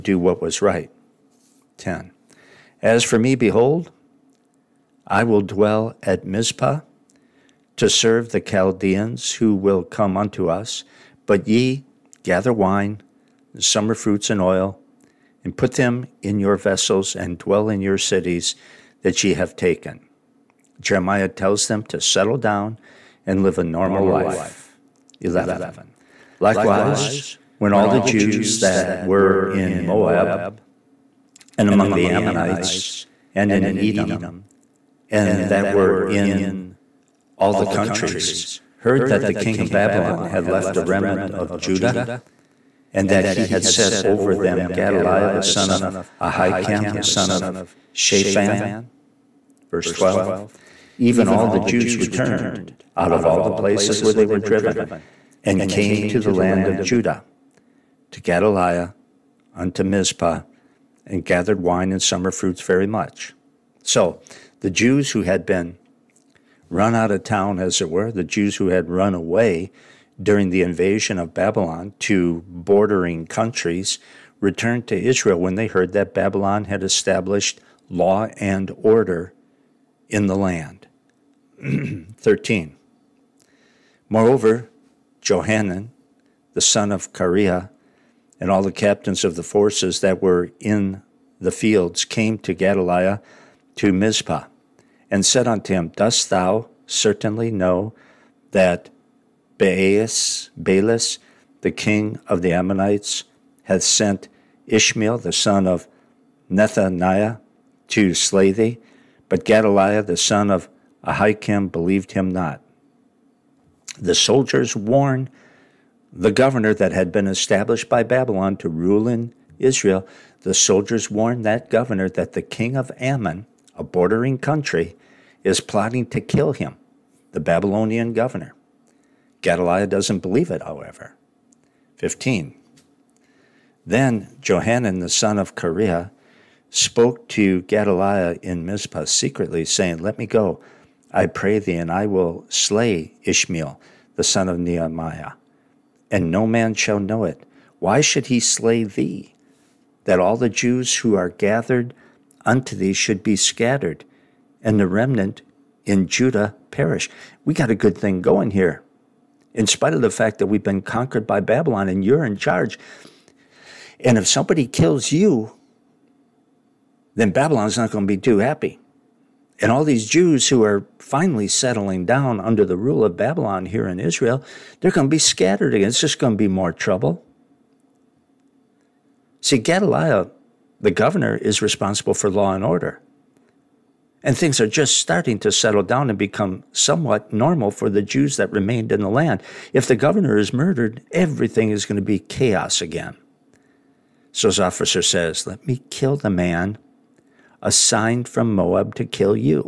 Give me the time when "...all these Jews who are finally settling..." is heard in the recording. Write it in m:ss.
2:49.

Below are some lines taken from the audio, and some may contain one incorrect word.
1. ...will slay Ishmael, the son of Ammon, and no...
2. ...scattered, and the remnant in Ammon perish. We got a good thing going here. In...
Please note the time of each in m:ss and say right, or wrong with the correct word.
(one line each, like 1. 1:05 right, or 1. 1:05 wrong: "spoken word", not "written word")
1. 2:22 wrong: "Nehemiah", not "Ammon"
2. 2:33 wrong: "Judah", not "Ammon".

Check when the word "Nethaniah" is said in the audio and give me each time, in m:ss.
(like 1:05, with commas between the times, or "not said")
1:46.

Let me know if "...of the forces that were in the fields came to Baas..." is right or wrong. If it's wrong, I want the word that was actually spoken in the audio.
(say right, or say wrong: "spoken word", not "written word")
wrong: "Gedaliah", not "Baas".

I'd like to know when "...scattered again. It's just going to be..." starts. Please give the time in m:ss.
2:55.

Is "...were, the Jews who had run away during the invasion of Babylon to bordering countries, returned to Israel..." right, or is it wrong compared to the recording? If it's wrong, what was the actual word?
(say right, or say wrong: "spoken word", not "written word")
right.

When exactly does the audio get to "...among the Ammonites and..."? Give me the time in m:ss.
0:31.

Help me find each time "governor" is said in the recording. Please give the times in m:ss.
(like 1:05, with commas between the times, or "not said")
1:56, 2:01, 2:08, 3:00, 3:09.